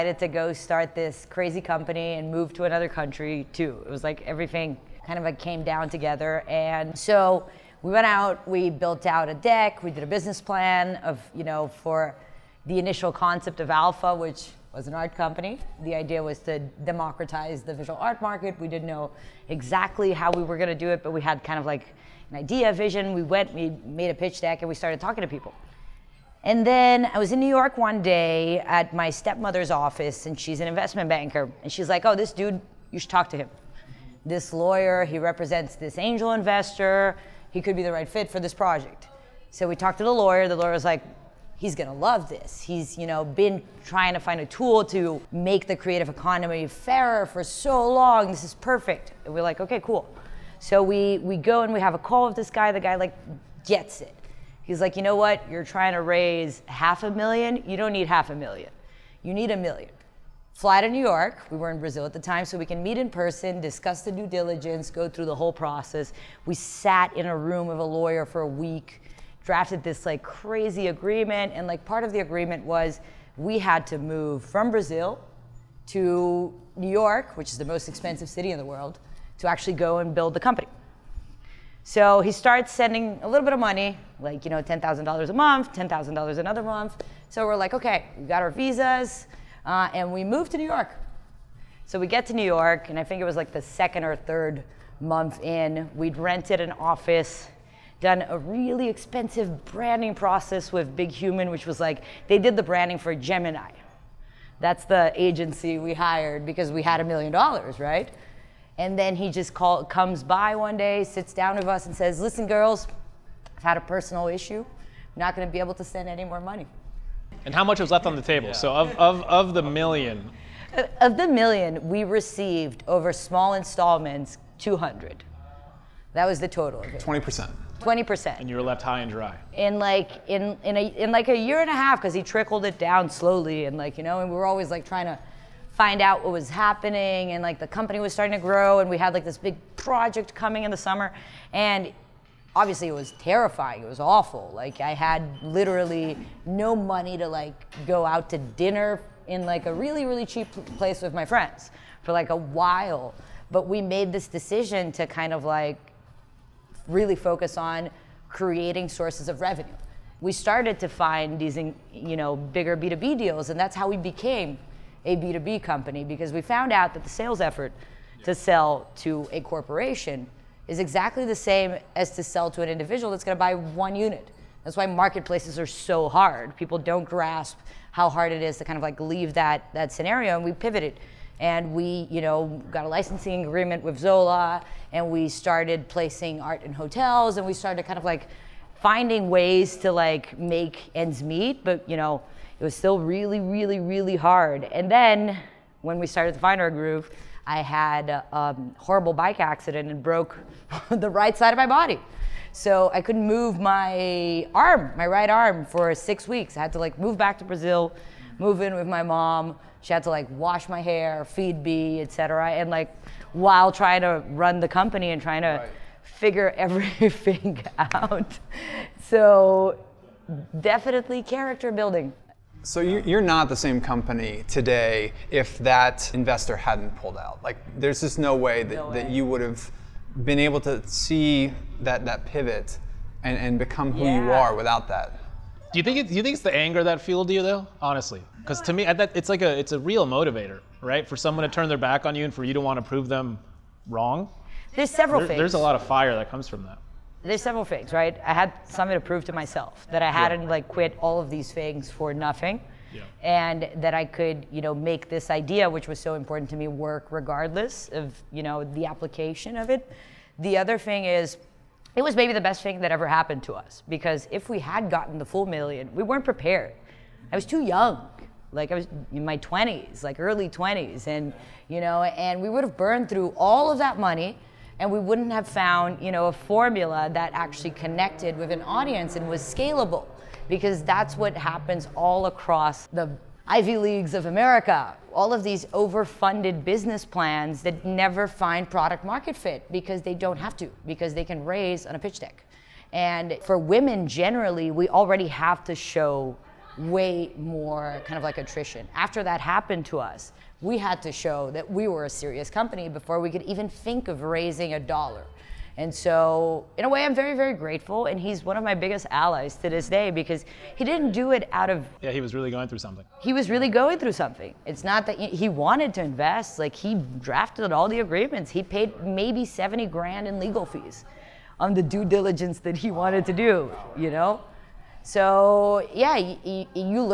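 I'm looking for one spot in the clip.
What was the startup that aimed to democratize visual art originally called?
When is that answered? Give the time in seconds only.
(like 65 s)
13 s.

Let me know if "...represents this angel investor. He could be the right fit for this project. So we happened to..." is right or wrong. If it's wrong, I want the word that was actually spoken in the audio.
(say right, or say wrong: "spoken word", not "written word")
wrong: "talked", not "happened".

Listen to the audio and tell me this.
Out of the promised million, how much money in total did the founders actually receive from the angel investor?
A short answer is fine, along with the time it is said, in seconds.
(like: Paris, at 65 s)
200, at 124 s.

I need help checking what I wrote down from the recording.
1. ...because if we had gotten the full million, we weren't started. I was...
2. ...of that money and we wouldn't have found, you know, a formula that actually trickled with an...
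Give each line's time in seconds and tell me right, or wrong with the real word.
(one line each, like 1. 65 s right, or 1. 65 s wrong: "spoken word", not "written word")
1. 263 s wrong: "prepared", not "started"
2. 273 s wrong: "connected", not "trickled".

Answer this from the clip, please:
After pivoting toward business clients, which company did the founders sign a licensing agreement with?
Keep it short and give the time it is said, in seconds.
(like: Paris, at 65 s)
Zola, at 183 s.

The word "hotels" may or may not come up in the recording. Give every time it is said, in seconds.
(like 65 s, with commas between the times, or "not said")
186 s.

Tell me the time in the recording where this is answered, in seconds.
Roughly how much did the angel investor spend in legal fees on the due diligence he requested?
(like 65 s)
319 s.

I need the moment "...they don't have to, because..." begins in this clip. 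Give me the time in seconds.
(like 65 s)
290 s.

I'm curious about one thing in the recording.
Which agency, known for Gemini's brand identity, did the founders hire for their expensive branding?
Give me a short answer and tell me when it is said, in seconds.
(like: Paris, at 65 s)
Big Human, at 100 s.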